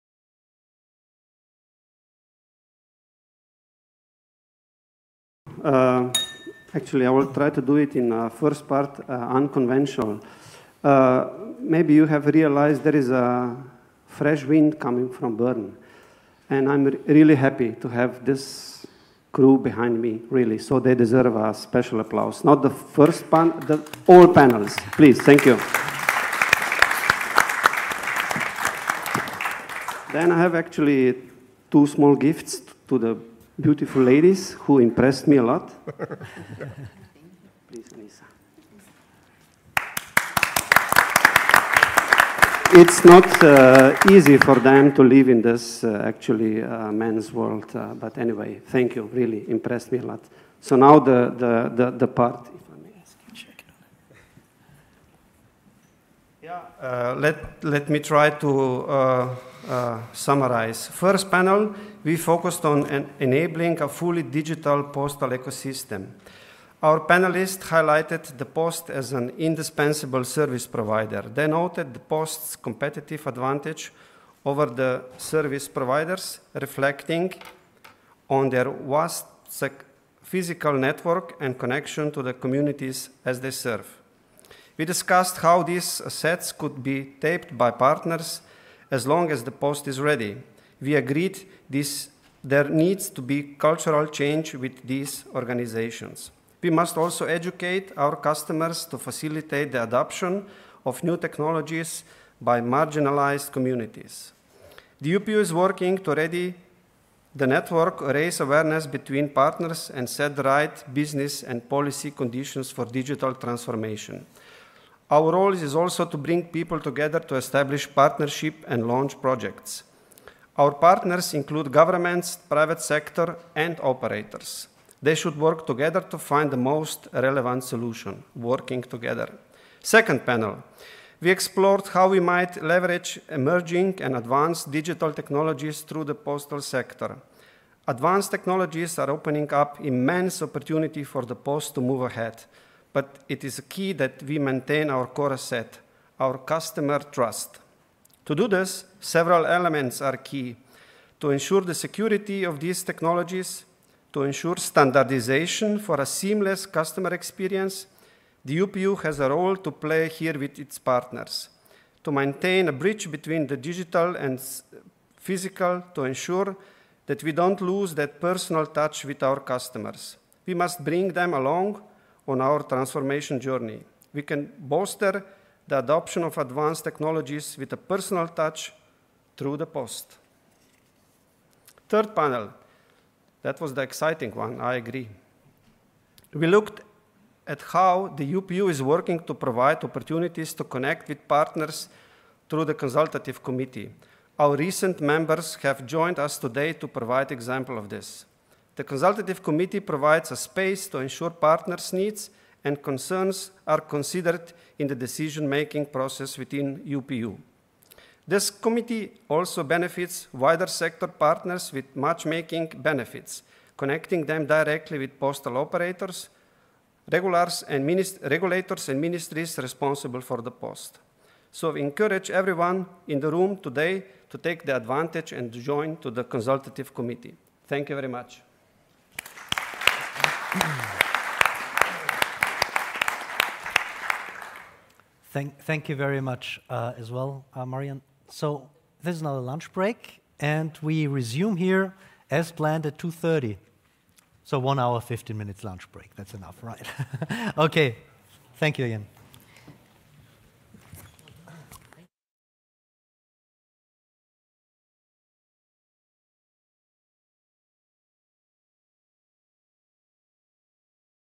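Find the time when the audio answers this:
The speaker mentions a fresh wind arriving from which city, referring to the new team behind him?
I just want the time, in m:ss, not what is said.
0:15.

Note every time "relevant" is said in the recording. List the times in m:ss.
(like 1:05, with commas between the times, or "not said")
2:07.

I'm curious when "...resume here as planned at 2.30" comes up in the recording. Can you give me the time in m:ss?
4:01.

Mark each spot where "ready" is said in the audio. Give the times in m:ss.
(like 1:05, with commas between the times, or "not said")
1:29, 1:46.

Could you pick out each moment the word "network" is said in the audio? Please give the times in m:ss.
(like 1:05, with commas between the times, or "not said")
1:20, 1:47.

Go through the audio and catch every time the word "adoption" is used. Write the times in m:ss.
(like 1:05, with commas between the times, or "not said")
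1:39, 2:55.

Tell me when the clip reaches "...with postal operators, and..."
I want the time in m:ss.
3:34.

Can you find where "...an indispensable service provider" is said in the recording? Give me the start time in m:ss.
1:09.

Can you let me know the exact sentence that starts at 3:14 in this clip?
Our recent members have joined us today to provide example of this.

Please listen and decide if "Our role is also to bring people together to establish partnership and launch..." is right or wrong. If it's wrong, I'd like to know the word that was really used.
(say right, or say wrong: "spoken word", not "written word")
right.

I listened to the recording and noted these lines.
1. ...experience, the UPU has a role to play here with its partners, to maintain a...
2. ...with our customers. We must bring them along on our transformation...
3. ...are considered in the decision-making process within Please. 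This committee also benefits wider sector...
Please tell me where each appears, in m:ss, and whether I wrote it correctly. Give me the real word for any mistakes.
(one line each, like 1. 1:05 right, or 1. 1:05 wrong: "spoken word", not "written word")
1. 2:37 right
2. 2:49 right
3. 3:23 wrong: "UPU", not "Please".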